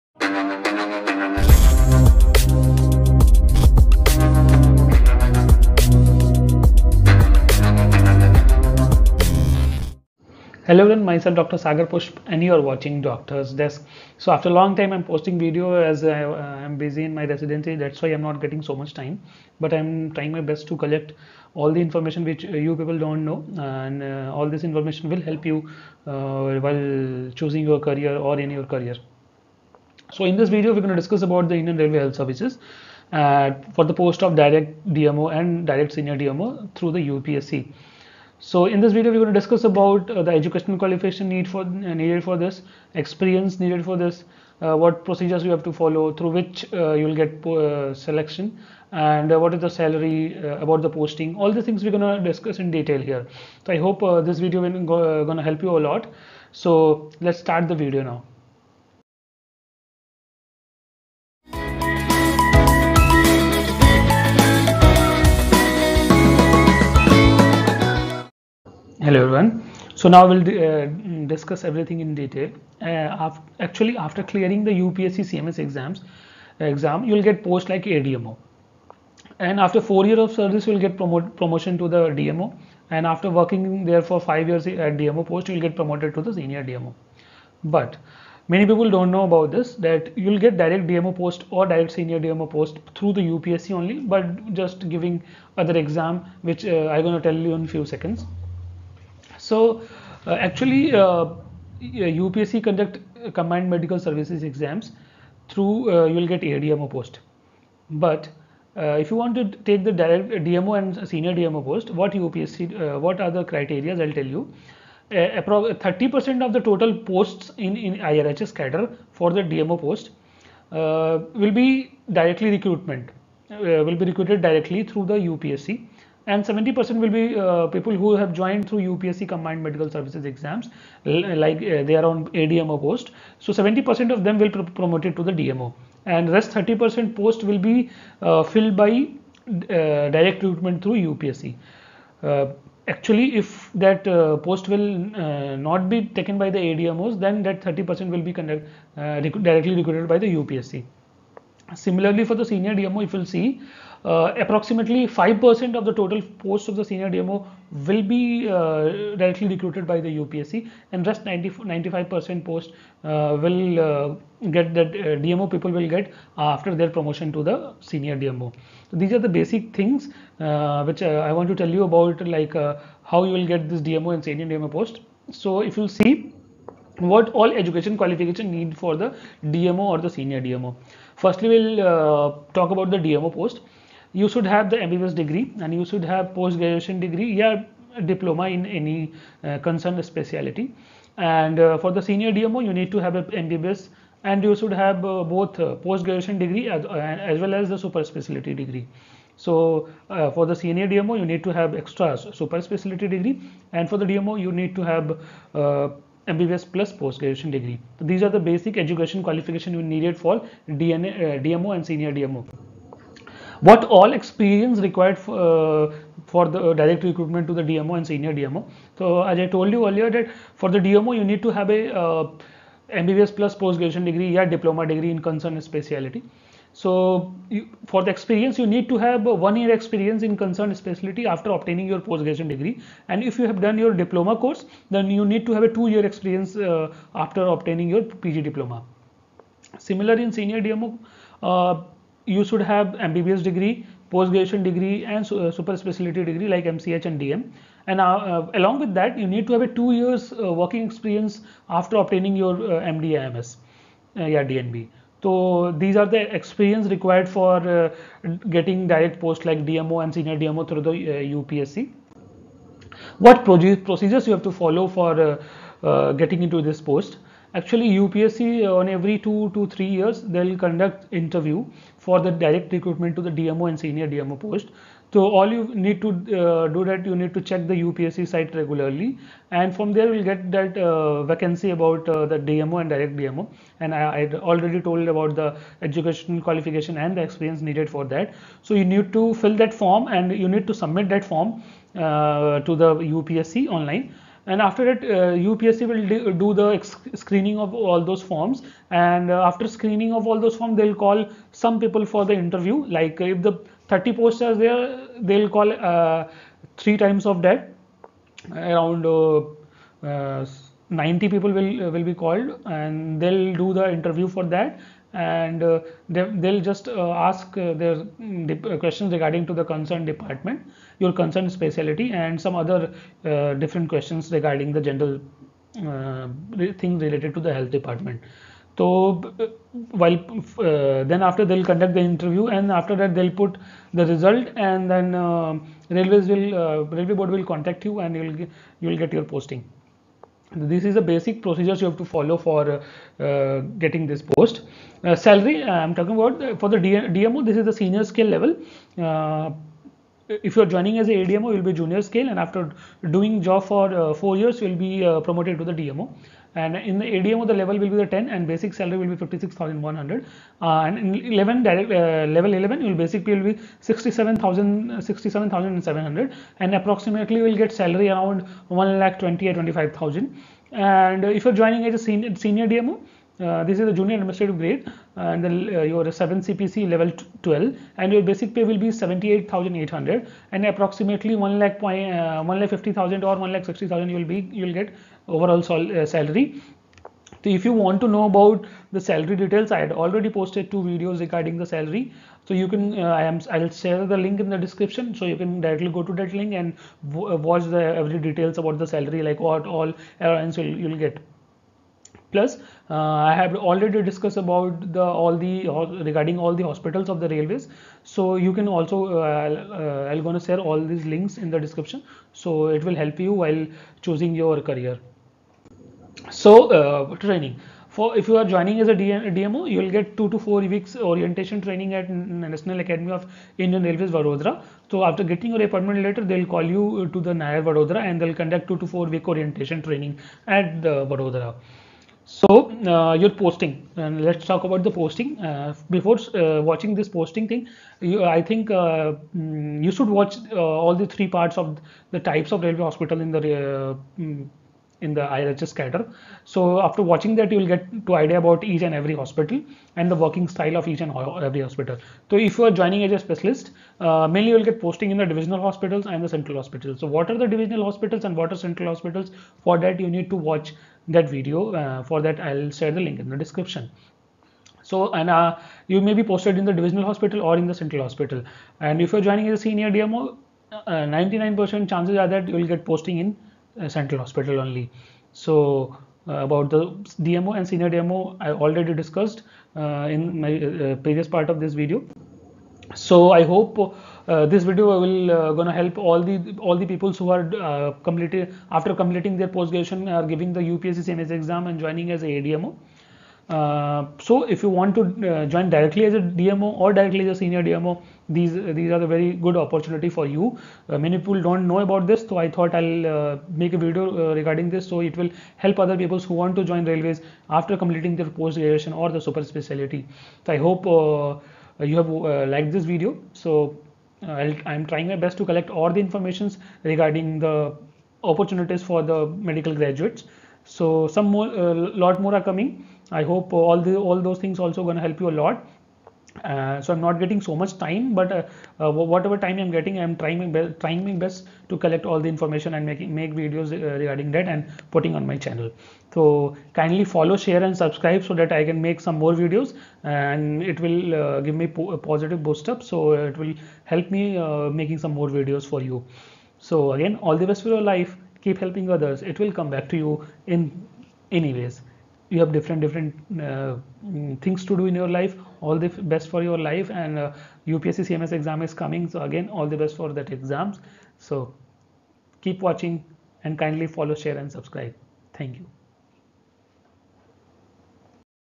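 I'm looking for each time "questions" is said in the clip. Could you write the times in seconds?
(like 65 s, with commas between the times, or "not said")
318 s, 323 s.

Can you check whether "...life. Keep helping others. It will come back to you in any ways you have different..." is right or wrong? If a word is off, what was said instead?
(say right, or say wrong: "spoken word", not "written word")
right.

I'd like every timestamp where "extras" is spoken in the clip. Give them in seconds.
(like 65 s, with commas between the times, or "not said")
201 s.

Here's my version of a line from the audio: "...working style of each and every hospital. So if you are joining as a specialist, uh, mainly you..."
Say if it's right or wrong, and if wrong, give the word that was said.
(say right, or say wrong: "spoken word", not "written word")
right.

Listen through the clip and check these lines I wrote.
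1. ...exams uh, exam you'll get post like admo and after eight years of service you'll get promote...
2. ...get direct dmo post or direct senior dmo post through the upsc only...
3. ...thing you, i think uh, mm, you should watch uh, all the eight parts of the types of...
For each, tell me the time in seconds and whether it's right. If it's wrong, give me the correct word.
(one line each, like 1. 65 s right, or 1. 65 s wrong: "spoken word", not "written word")
1. 75 s wrong: "four", not "eight"
2. 90 s right
3. 437 s wrong: "three", not "eight".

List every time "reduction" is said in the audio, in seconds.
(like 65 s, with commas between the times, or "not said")
not said.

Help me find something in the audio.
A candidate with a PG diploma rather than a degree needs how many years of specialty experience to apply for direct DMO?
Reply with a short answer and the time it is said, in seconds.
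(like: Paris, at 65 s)
2 years, at 235 s.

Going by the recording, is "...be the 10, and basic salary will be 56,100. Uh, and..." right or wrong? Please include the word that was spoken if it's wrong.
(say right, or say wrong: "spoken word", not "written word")
right.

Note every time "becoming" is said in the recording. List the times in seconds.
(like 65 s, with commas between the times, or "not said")
not said.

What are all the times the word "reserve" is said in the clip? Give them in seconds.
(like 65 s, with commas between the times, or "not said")
not said.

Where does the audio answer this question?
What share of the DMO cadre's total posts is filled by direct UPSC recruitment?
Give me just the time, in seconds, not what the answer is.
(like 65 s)
115 s.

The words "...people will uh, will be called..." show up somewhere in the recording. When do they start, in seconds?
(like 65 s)
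311 s.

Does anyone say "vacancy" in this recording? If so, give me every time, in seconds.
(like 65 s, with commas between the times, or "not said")
281 s.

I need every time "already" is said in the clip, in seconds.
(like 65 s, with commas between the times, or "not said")
284 s, 389 s, 403 s, 478 s.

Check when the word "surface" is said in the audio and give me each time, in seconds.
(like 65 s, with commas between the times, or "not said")
not said.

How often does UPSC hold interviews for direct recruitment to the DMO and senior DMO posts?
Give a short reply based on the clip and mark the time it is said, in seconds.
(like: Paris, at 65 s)
every 2 to 3 years, at 268 s.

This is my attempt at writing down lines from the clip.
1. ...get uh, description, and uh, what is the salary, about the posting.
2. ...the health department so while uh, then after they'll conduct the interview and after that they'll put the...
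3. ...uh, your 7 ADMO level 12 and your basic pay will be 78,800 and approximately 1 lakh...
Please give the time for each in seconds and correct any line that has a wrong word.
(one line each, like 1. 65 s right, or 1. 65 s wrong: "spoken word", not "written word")
1. 47 s wrong: "selection", not "description"
2. 327 s right
3. 375 s wrong: "CPC", not "ADMO".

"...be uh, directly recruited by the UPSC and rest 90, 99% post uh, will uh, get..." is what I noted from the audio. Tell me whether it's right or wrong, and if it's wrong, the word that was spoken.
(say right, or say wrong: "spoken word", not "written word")
wrong: "95", not "99".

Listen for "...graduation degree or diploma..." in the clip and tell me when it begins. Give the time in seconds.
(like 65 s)
223 s.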